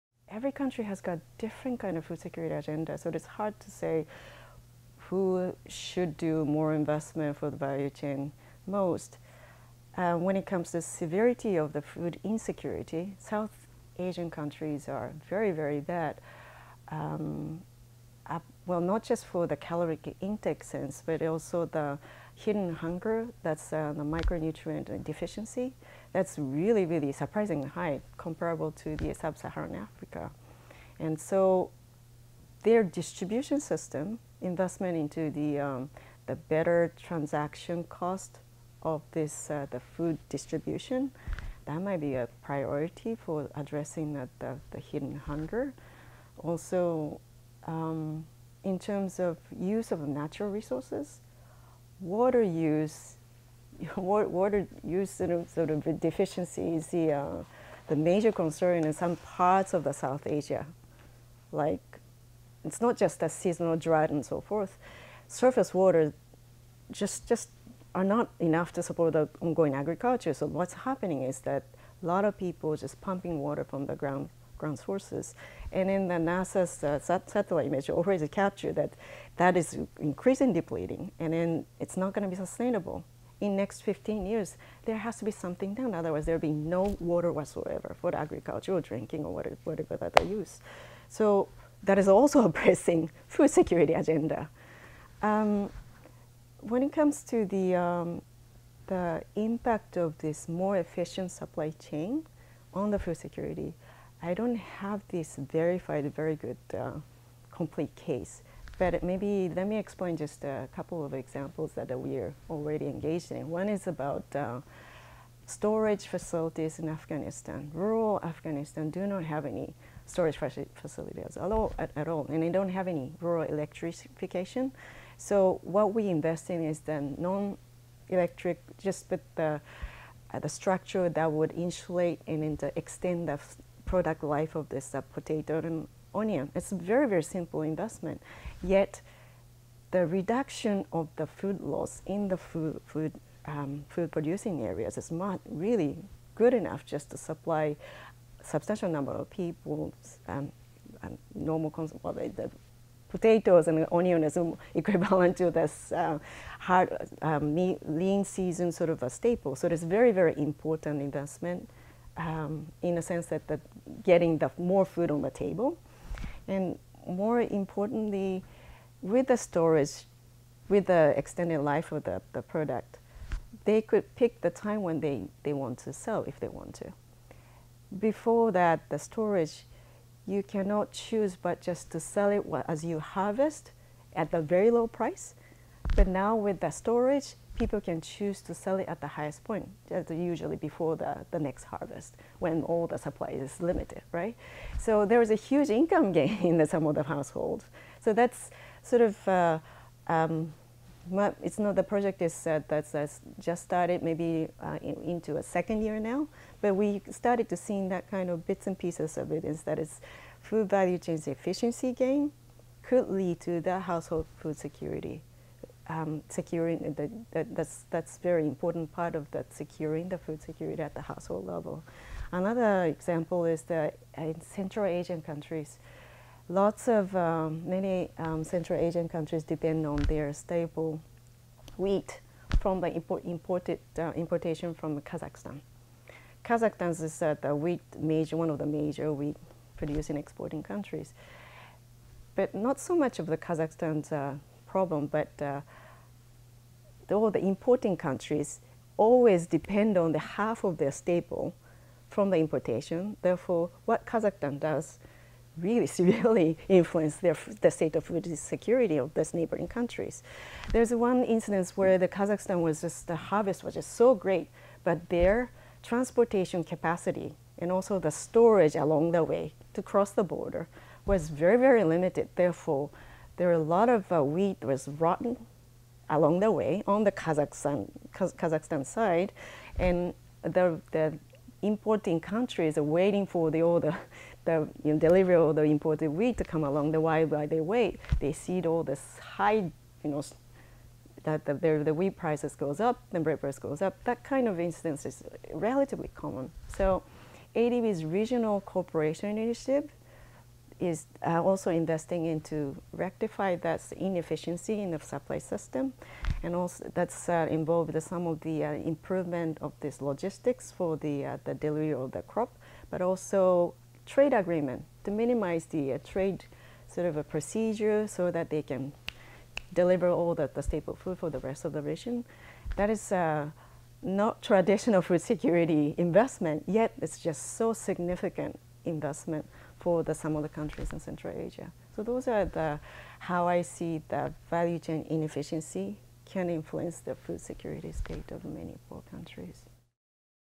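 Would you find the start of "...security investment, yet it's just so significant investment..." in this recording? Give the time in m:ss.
5:25.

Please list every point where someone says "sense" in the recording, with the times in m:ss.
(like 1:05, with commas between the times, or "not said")
0:20, 2:43.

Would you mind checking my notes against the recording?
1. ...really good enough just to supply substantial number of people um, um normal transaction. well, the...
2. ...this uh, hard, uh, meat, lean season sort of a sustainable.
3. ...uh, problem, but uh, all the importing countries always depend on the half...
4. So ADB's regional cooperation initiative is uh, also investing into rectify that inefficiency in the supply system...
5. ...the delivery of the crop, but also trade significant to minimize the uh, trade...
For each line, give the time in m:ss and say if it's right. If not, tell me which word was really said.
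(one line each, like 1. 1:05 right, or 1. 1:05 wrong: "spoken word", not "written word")
1. 2:25 wrong: "consumption", not "transaction"
2. 2:35 wrong: "staple", not "sustainable"
3. 4:04 right
4. 4:56 right
5. 5:11 wrong: "agreement", not "significant".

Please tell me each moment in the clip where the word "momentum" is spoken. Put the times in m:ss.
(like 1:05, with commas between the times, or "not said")
not said.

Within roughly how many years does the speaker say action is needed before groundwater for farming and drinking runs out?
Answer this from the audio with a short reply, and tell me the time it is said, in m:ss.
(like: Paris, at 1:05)
15 years, at 1:23.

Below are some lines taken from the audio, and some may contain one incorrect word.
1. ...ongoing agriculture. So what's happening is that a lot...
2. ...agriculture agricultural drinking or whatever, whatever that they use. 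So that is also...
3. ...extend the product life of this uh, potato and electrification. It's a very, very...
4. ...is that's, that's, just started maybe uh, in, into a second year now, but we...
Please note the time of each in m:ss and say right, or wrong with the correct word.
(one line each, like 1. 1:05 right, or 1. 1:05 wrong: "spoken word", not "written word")
1. 1:09 right
2. 1:28 right
3. 2:12 wrong: "onion", not "electrification"
4. 3:22 right.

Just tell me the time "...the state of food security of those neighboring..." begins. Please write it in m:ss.
4:17.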